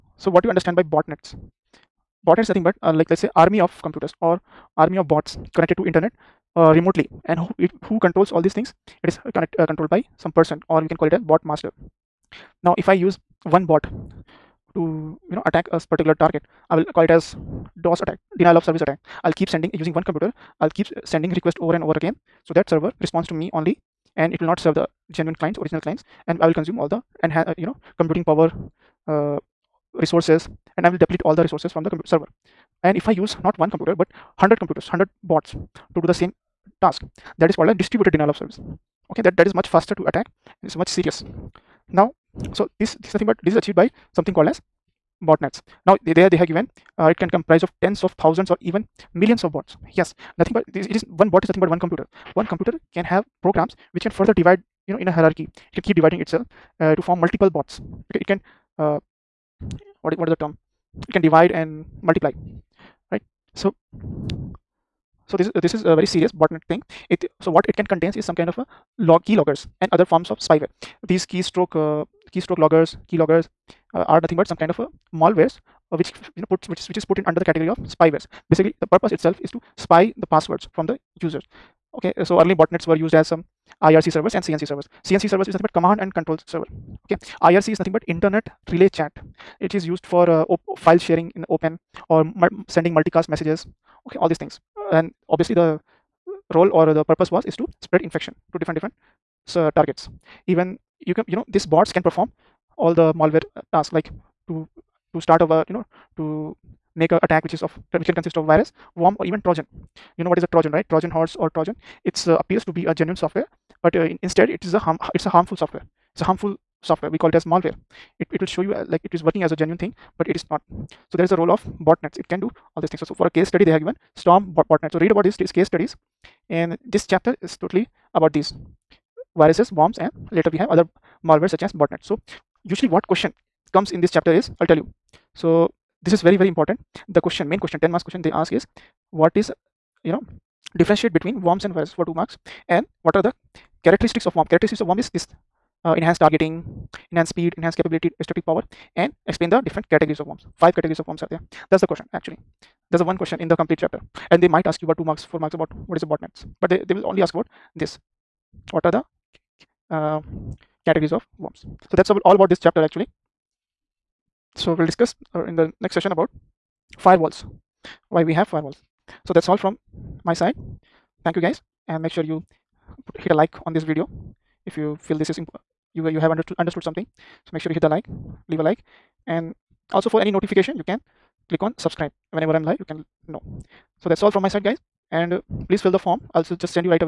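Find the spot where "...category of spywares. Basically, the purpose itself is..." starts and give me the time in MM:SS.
01:17.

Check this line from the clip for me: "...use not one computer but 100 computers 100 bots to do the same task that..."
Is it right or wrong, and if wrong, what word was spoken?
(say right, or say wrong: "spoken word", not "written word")
right.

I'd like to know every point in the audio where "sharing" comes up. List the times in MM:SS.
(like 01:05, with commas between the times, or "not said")
01:30.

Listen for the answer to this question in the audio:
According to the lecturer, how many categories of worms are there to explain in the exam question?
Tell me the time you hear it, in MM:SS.
02:30.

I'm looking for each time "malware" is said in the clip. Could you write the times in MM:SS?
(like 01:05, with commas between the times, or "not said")
01:15, 01:43, 01:57, 02:11.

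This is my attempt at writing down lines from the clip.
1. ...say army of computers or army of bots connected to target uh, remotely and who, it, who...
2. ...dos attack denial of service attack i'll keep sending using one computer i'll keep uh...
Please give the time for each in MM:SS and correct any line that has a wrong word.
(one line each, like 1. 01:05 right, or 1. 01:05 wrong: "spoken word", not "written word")
1. 00:03 wrong: "internet", not "target"
2. 00:17 right.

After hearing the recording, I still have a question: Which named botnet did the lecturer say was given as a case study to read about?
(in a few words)
Storm botnet.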